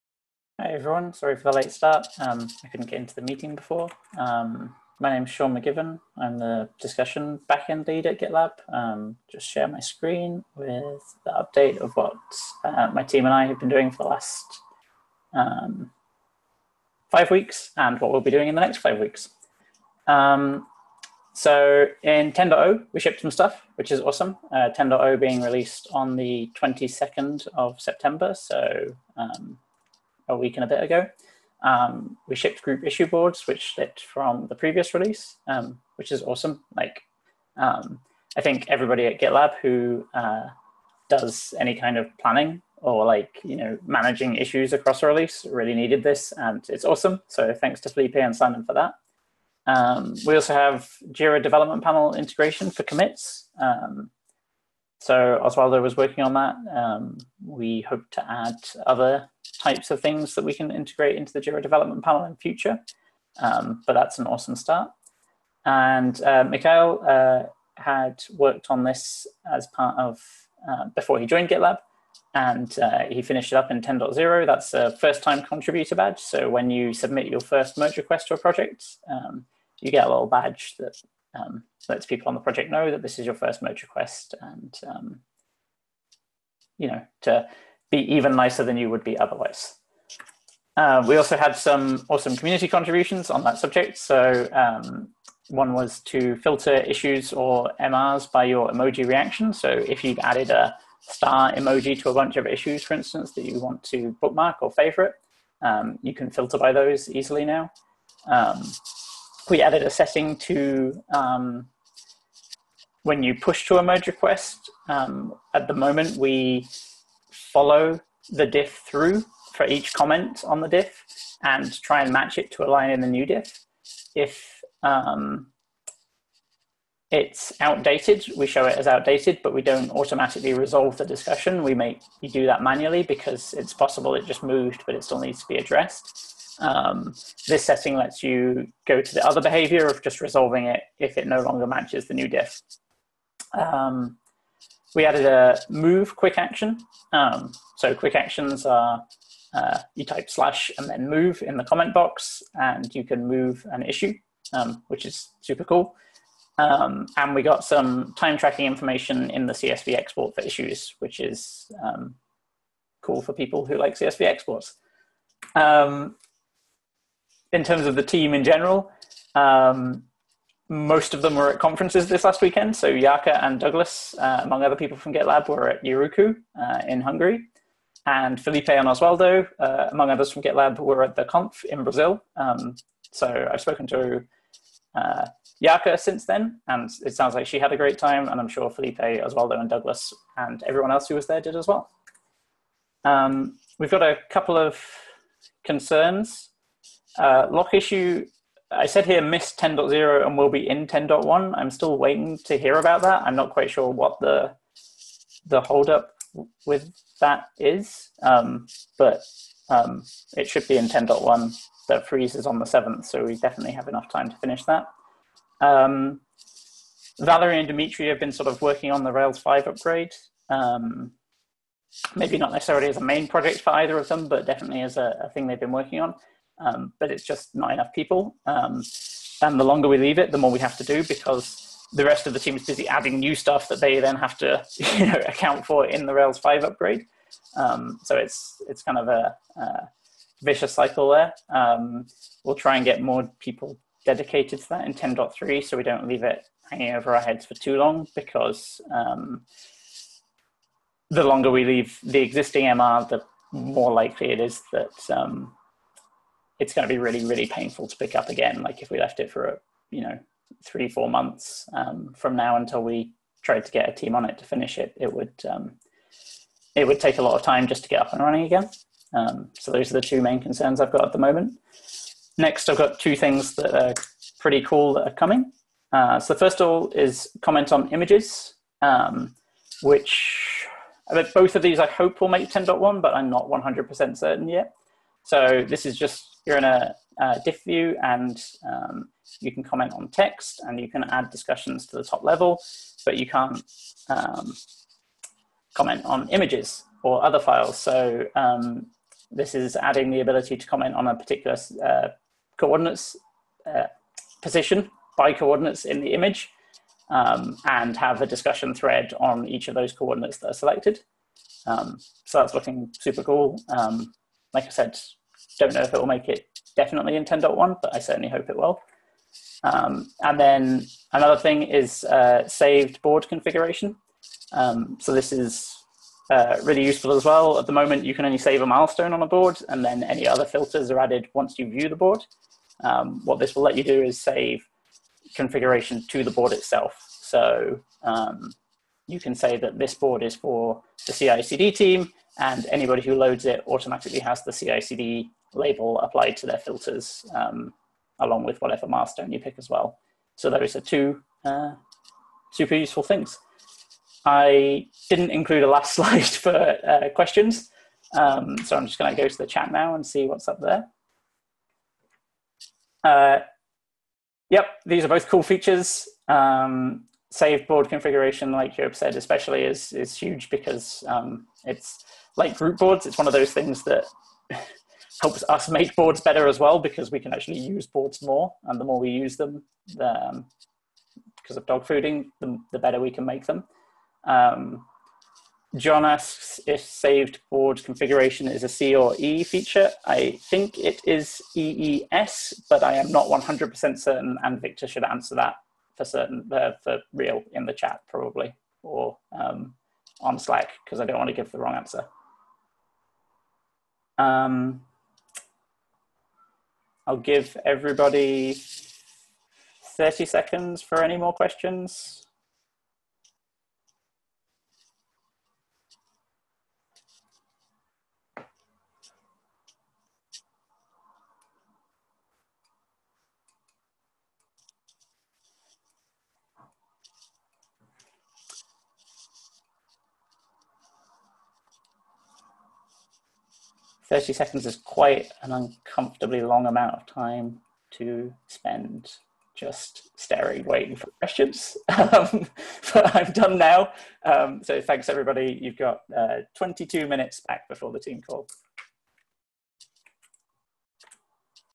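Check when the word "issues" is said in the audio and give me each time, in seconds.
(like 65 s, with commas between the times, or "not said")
32 s, 44 s, 96 s, 102 s, 153 s, 160 s, 197 s.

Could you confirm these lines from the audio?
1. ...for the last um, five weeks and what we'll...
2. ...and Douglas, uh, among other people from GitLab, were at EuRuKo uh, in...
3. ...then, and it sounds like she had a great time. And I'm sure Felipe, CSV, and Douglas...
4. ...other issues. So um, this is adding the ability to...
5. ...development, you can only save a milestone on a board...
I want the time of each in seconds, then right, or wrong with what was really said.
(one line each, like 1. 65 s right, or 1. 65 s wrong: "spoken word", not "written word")
1. 13 s right
2. 173 s right
3. 186 s wrong: "Oswaldo", not "CSV"
4. 297 s wrong: "files", not "issues"
5. 327 s wrong: "moment", not "development".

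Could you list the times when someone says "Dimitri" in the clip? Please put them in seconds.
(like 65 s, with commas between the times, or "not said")
217 s.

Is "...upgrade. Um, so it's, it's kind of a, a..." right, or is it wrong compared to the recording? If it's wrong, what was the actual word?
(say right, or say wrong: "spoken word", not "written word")
right.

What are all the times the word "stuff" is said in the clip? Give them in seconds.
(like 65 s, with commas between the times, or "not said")
23 s, 233 s.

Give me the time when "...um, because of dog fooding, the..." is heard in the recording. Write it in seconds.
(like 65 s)
380 s.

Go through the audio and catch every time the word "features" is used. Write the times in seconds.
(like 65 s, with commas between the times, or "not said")
365 s, 389 s.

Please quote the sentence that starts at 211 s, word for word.
That freeze is on the 7th, so we definitely have enough time to finish that.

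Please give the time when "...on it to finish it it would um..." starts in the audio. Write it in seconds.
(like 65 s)
264 s.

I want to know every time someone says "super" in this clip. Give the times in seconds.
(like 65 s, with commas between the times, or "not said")
155 s, 312 s, 352 s.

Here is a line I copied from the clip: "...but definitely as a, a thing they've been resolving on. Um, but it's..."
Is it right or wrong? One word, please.
wrong.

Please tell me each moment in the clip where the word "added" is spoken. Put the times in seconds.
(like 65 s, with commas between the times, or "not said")
100 s, 109 s, 145 s, 330 s.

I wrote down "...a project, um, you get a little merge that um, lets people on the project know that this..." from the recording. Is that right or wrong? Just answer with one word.
wrong.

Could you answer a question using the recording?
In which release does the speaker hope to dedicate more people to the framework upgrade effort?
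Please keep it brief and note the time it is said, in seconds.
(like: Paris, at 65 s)
10.3, at 244 s.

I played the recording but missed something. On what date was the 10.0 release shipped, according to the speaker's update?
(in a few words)
22nd of September.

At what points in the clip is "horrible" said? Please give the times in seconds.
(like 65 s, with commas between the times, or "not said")
not said.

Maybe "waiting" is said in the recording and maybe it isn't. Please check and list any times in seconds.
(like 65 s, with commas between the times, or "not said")
201 s, 440 s.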